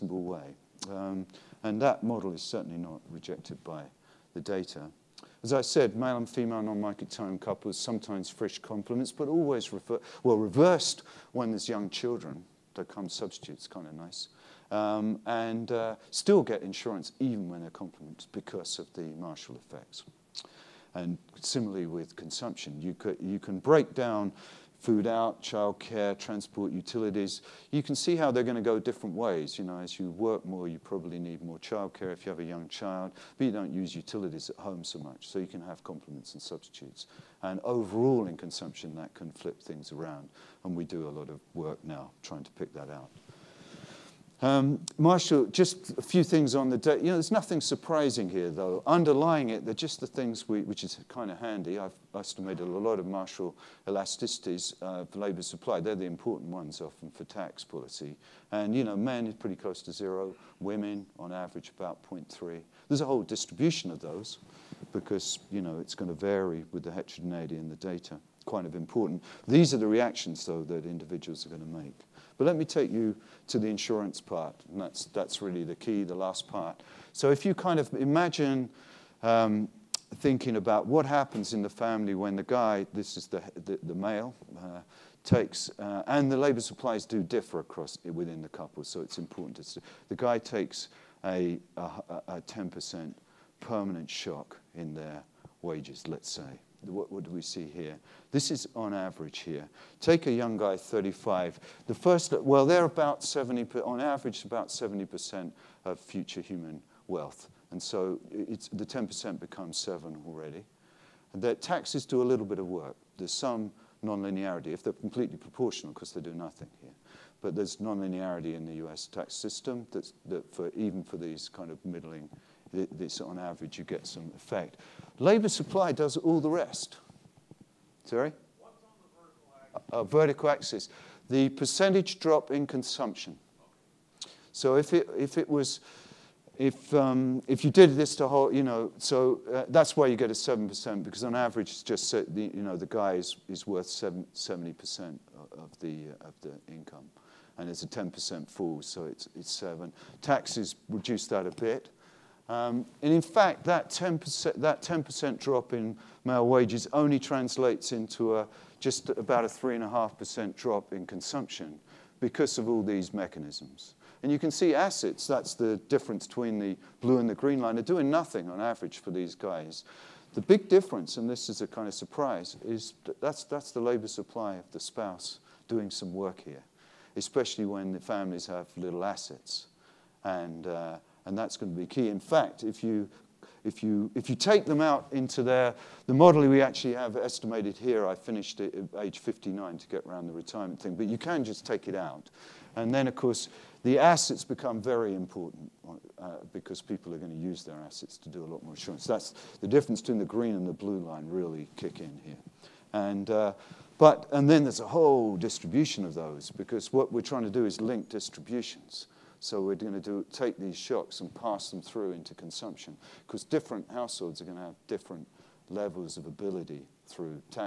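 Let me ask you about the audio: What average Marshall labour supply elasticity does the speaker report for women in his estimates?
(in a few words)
0.3.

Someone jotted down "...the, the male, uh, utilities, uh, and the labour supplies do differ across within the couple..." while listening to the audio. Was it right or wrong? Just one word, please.
wrong.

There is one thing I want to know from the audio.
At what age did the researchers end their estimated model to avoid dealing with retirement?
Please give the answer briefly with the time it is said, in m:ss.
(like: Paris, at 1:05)
59, at 3:09.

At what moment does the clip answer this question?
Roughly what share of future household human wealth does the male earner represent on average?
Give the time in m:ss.
1:44.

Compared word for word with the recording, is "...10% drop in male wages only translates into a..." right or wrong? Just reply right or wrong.
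right.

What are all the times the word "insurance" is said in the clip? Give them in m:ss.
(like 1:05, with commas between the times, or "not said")
0:16, 1:13, 3:18.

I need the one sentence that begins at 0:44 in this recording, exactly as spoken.
Um, Marshall, just a few things on the day.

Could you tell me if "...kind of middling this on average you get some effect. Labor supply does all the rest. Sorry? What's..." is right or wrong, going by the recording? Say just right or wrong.
right.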